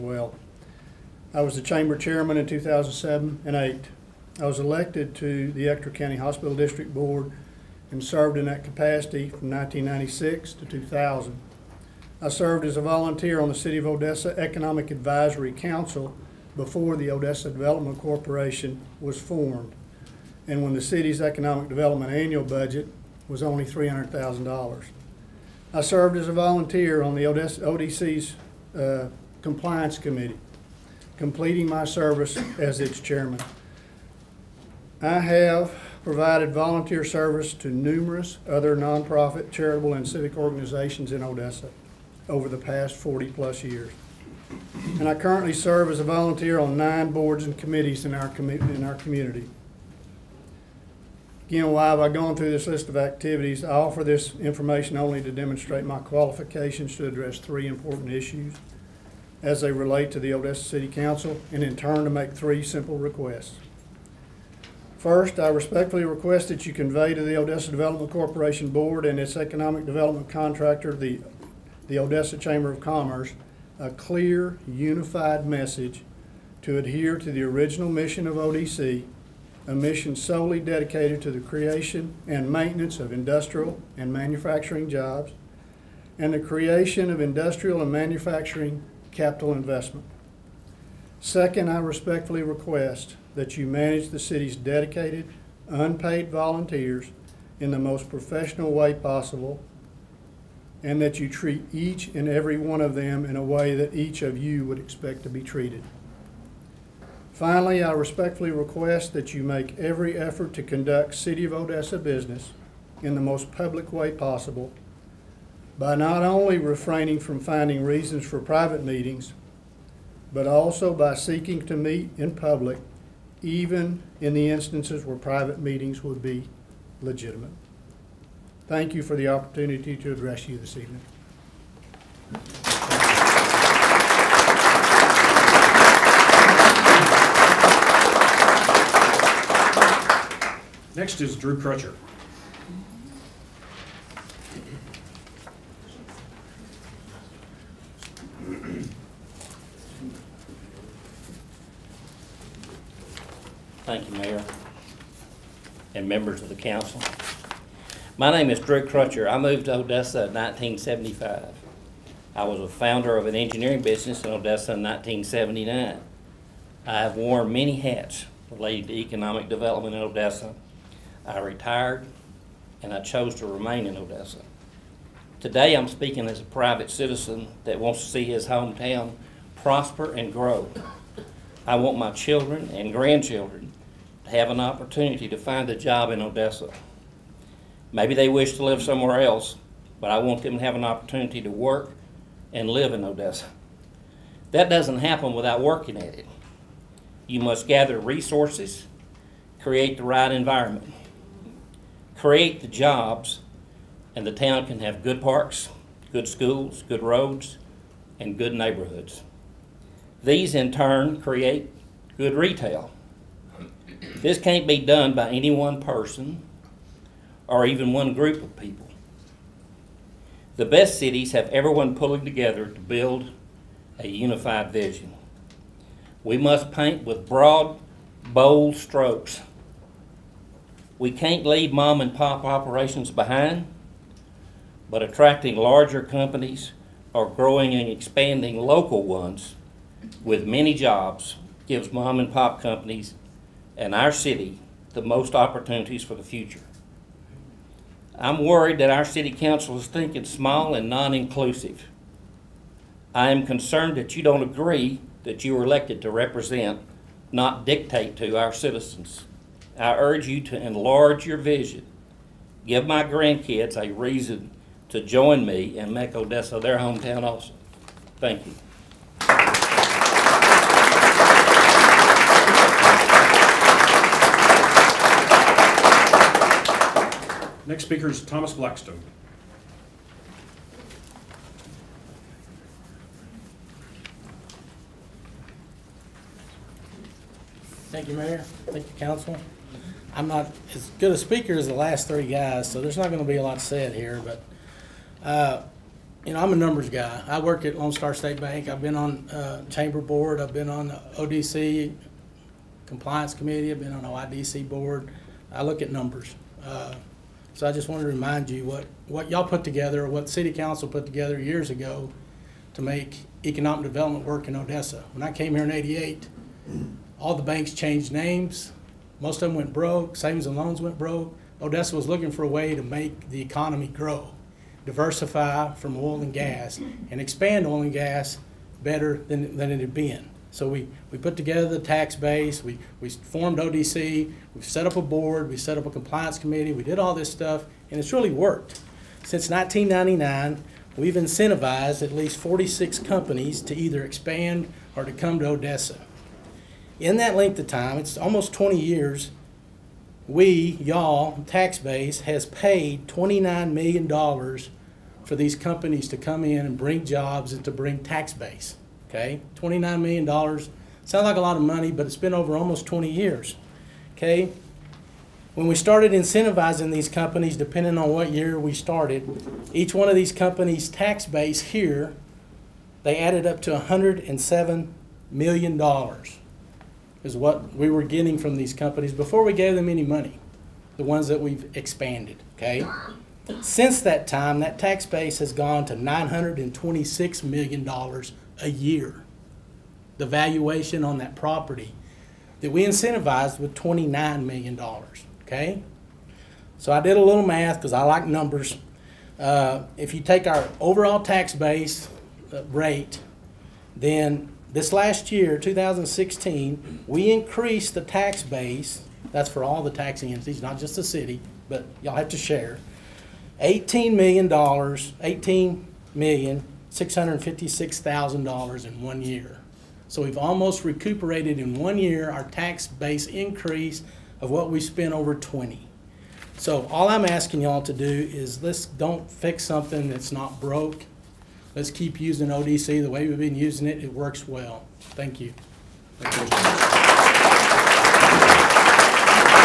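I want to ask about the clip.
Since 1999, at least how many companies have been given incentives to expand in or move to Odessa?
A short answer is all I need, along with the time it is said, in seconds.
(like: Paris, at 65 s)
46, at 342 s.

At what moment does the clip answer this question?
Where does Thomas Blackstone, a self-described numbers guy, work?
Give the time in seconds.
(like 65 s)
297 s.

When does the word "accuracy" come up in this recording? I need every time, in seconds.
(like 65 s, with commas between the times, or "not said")
not said.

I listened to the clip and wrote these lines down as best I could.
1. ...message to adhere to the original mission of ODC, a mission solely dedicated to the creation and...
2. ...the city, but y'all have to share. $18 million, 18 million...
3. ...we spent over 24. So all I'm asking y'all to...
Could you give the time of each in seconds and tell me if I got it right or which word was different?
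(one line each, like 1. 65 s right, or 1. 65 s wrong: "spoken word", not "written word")
1. 75 s right
2. 410 s right
3. 424 s wrong: "20", not "24".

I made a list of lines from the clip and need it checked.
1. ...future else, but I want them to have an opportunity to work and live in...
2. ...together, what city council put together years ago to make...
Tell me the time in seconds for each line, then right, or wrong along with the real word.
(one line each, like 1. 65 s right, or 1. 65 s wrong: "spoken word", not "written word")
1. 188 s wrong: "somewhere", not "future"
2. 309 s right.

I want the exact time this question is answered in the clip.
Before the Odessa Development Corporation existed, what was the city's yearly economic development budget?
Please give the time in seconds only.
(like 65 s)
23 s.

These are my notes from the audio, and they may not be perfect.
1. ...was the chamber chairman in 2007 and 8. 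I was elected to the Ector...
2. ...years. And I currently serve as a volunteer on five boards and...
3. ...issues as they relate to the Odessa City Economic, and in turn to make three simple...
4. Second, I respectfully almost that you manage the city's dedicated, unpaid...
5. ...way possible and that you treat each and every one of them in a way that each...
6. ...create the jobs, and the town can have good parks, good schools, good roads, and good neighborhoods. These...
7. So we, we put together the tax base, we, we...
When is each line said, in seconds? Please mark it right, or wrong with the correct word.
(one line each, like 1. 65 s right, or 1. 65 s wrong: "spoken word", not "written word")
1. 1 s right
2. 43 s wrong: "nine", not "five"
3. 58 s wrong: "Council", not "Economic"
4. 91 s wrong: "request", not "almost"
5. 98 s right
6. 202 s right
7. 330 s right.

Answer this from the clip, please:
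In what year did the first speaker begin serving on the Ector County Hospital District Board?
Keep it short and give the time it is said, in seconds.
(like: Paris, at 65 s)
1996, at 9 s.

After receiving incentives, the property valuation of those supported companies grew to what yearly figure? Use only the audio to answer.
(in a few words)
$926 million.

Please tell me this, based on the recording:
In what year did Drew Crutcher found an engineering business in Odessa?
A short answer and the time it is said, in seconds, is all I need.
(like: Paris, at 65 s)
1979, at 164 s.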